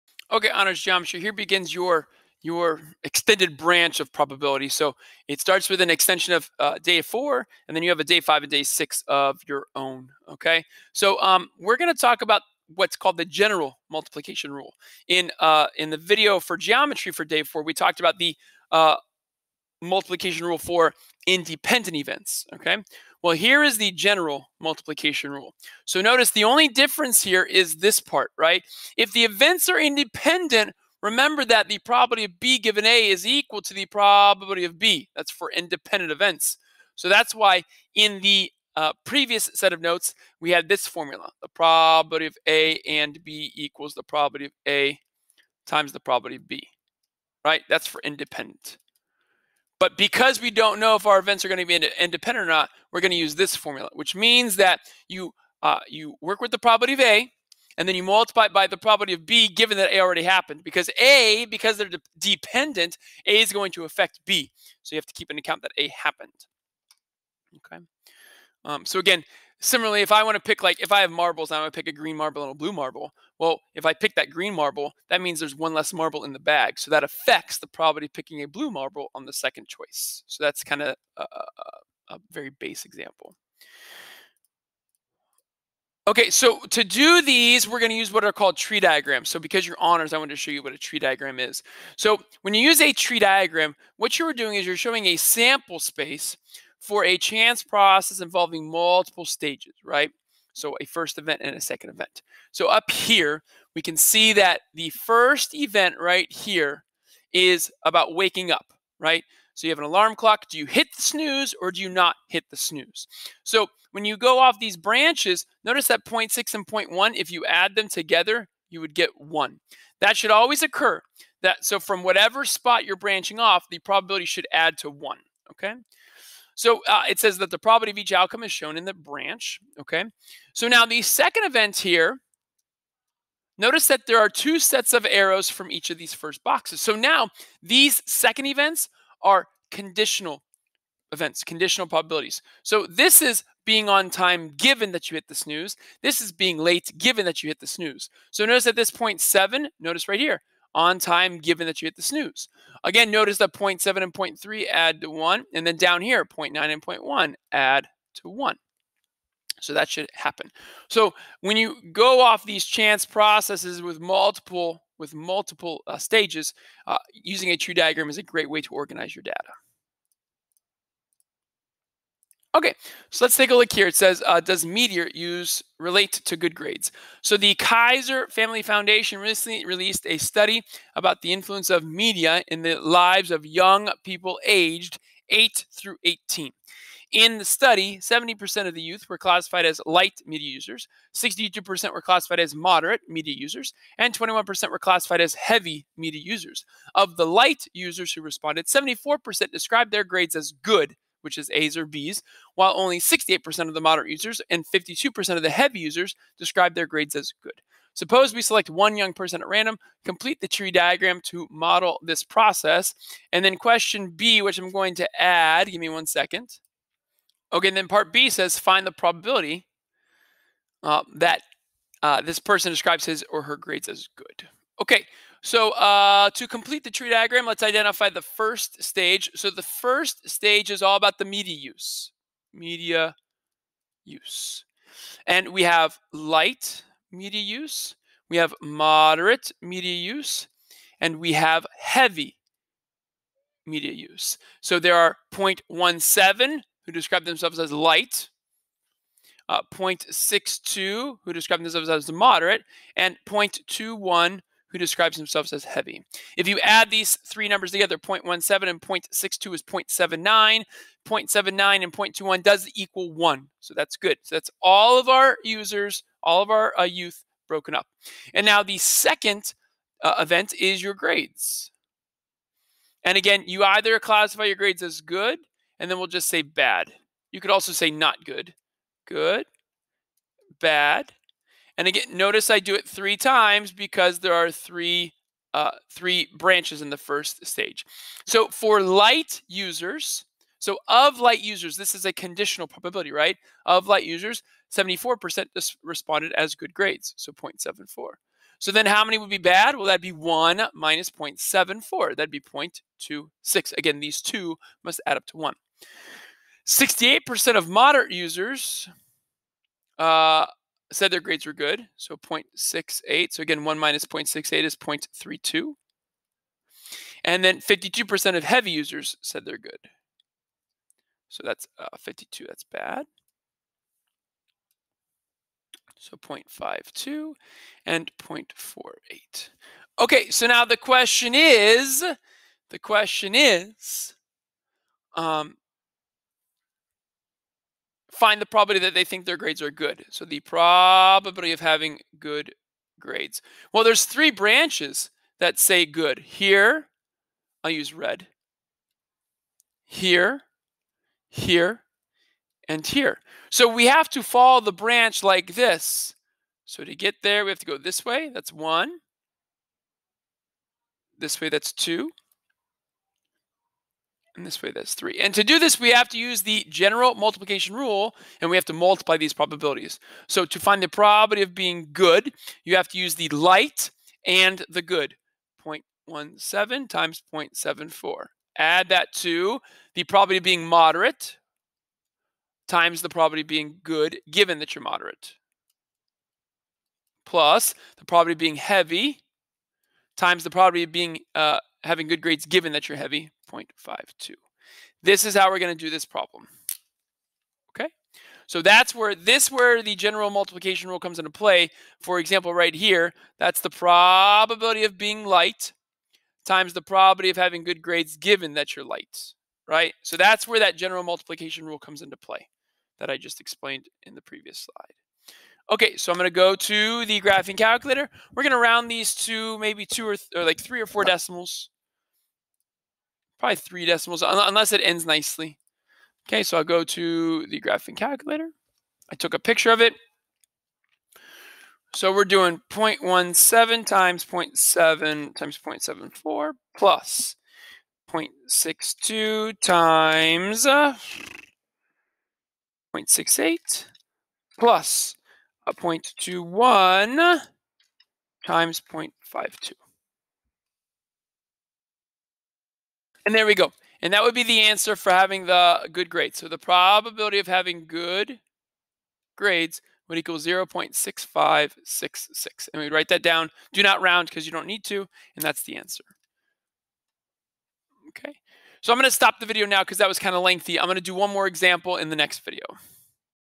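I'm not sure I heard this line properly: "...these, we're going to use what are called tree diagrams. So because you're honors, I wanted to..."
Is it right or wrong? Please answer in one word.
right.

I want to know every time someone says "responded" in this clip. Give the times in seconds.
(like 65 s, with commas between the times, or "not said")
198 s, 295 s.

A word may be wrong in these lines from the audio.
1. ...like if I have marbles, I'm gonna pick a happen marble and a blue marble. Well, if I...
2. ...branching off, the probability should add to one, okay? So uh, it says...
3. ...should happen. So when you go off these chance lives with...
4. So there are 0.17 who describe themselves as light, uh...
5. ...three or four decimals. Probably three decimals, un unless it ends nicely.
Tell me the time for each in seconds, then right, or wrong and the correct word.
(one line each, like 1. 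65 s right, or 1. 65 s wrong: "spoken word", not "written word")
1. 70 s wrong: "green", not "happen"
2. 122 s right
3. 159 s wrong: "processes", not "lives"
4. 244 s right
5. 420 s right.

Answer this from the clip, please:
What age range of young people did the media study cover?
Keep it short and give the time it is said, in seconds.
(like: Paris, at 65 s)
8 through 18, at 185 s.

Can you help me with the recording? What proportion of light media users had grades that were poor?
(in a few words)
0.26.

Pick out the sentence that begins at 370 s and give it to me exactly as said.
So to find the probability of being good, you have to use the light and the good.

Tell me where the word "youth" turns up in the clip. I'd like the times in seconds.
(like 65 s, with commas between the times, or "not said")
188 s, 266 s.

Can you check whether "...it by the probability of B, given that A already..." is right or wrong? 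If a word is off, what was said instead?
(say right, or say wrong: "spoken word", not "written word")
right.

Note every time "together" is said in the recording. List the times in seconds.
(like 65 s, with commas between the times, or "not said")
117 s, 257 s.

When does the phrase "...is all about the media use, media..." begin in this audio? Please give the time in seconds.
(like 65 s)
230 s.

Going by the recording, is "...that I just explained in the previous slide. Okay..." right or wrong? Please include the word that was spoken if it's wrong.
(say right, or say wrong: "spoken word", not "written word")
right.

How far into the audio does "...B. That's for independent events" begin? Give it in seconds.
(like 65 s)
34 s.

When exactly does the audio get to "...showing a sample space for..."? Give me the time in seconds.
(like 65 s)
94 s.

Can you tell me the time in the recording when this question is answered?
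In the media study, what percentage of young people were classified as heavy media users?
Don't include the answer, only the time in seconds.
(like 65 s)
194 s.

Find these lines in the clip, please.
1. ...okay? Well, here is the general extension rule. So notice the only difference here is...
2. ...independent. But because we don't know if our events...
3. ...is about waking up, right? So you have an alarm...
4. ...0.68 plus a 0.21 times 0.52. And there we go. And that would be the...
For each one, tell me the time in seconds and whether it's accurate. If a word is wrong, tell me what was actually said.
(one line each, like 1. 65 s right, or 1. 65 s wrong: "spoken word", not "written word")
1. 22 s wrong: "multiplication", not "extension"
2. 48 s right
3. 107 s right
4. 442 s right.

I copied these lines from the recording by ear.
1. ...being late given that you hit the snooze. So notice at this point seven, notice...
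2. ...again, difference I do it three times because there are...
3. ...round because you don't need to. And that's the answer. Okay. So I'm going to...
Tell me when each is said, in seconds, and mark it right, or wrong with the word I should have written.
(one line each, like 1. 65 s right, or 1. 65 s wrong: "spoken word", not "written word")
1. 146 s right
2. 281 s wrong: "notice", not "difference"
3. 464 s right.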